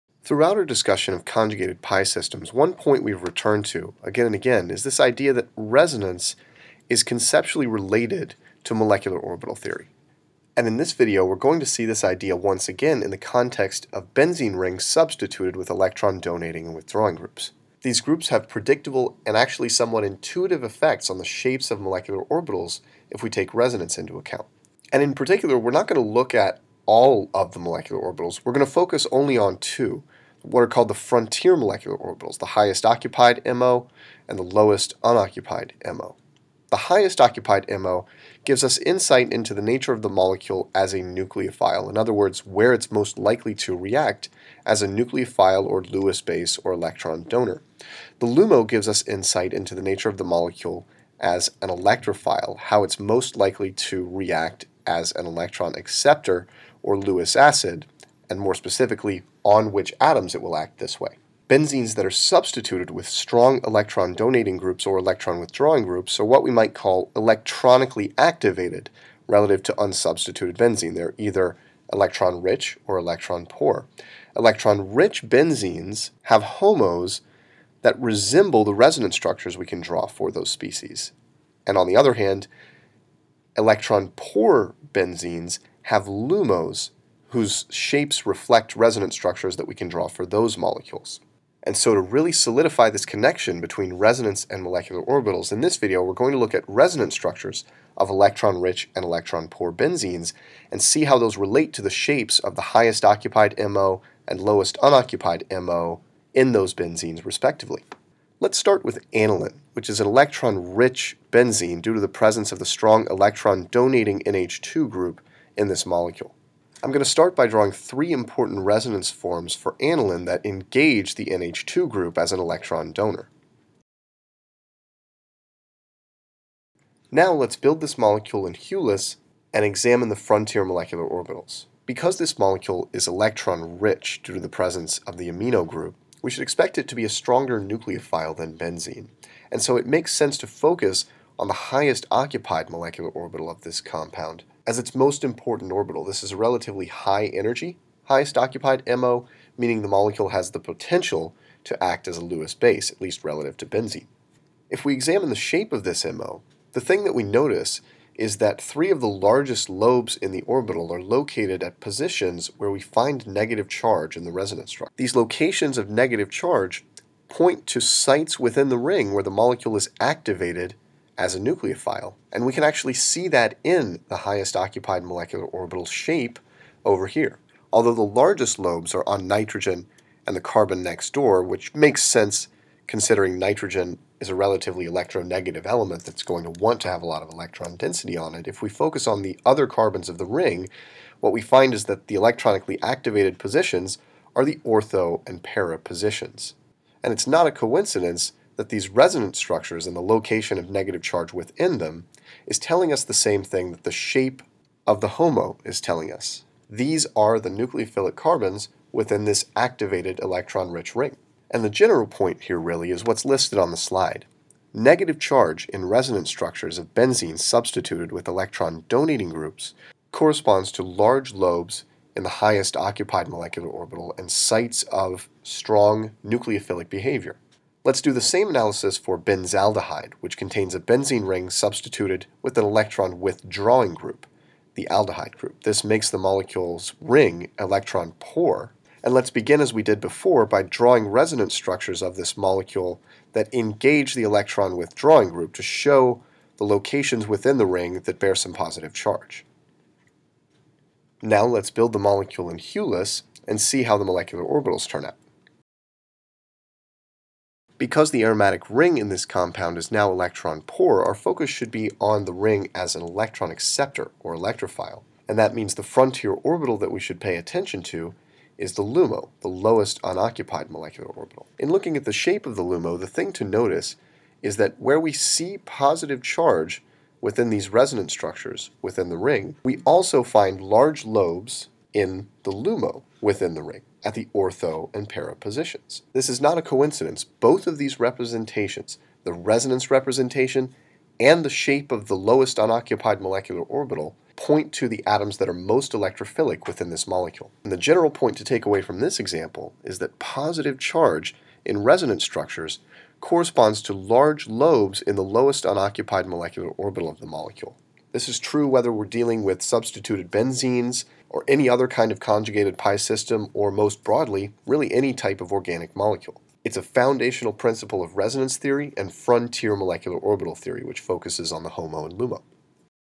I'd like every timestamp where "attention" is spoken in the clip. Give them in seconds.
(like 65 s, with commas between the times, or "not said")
267 s.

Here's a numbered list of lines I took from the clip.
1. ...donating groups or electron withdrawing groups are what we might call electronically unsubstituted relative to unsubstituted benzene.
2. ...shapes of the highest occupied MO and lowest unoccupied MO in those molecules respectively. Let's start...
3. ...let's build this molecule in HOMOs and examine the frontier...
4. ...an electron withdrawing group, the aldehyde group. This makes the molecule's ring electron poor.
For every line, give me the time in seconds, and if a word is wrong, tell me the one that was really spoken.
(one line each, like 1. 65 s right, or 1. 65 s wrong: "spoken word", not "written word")
1. 64 s wrong: "activated", not "unsubstituted"
2. 101 s wrong: "benzenes", not "molecules"
3. 127 s wrong: "Hulis", not "HOMOs"
4. 232 s right.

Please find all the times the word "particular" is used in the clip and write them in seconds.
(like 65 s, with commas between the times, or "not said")
25 s.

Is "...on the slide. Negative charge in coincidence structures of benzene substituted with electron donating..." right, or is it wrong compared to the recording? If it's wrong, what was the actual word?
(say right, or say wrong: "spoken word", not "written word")
wrong: "resonance", not "coincidence".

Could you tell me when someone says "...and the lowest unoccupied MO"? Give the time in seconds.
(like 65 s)
34 s.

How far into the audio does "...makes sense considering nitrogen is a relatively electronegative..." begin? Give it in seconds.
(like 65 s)
181 s.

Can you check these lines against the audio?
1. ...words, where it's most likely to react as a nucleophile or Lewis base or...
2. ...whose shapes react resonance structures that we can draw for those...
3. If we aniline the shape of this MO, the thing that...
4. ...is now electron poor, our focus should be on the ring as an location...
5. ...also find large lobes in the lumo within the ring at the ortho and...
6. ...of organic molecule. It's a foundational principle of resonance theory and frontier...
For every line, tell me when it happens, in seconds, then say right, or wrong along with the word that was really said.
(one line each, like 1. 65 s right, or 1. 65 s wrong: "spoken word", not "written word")
1. 42 s right
2. 87 s wrong: "reflect", not "react"
3. 154 s wrong: "examine", not "aniline"
4. 259 s wrong: "electron", not "location"
5. 279 s right
6. 315 s right.